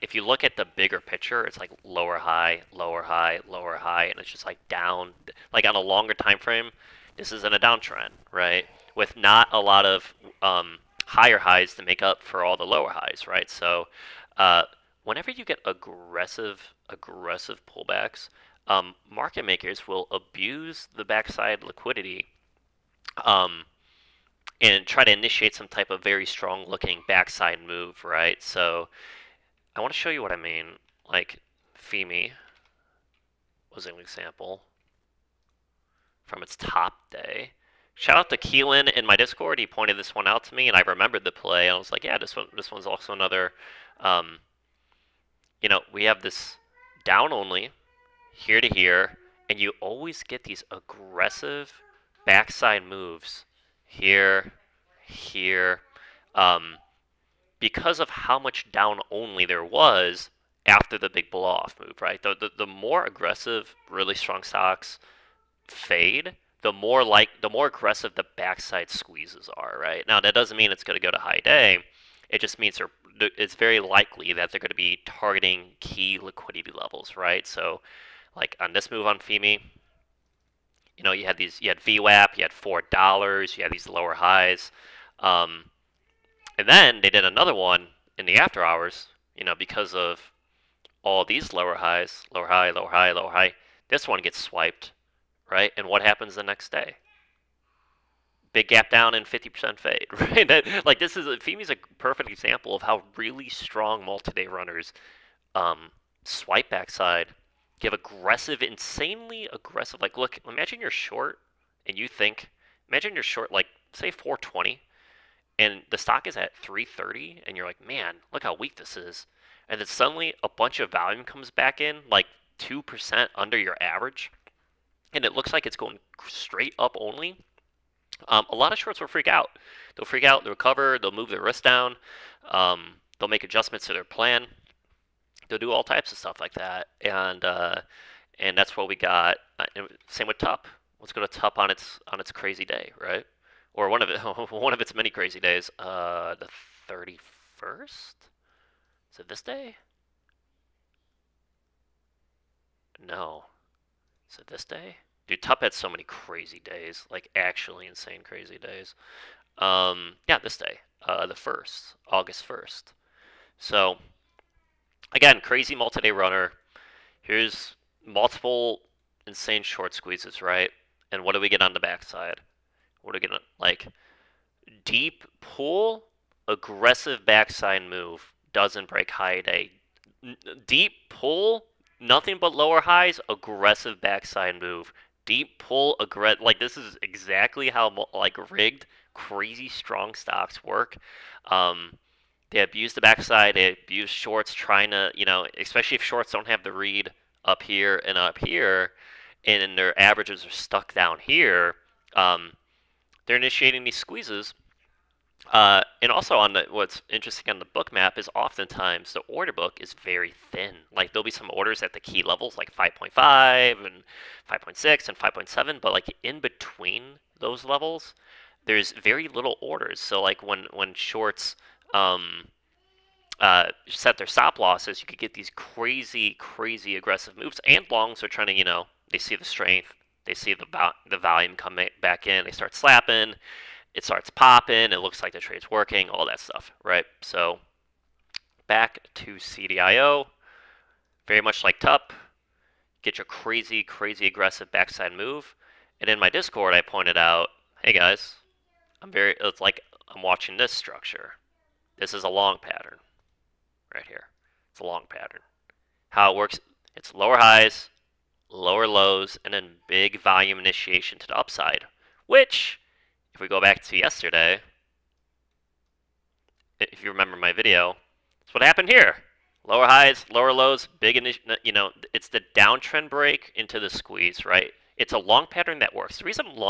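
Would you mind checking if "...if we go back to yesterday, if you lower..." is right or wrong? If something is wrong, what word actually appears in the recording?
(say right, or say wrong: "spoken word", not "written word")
wrong: "remember", not "lower".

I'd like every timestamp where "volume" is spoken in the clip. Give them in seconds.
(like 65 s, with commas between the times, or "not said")
120 s, 231 s, 260 s.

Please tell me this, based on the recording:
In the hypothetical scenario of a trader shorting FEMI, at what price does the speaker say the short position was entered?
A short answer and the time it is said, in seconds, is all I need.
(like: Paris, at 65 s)
420, at 114 s.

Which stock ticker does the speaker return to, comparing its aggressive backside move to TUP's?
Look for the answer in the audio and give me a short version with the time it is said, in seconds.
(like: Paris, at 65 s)
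CDIO, at 239 s.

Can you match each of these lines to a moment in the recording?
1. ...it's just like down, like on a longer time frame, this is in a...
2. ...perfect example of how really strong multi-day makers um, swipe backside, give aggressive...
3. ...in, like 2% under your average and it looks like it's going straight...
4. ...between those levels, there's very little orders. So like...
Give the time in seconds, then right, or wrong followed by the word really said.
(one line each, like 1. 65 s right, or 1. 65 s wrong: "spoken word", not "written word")
1. 4 s right
2. 101 s wrong: "runners", not "makers"
3. 121 s right
4. 216 s right.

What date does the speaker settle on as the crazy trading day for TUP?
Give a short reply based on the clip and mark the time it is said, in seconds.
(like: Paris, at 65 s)
August 1st, at 162 s.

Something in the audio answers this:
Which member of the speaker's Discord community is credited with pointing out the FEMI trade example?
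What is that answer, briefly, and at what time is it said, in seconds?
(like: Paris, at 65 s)
Keelan, at 38 s.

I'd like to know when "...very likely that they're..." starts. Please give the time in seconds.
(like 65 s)
73 s.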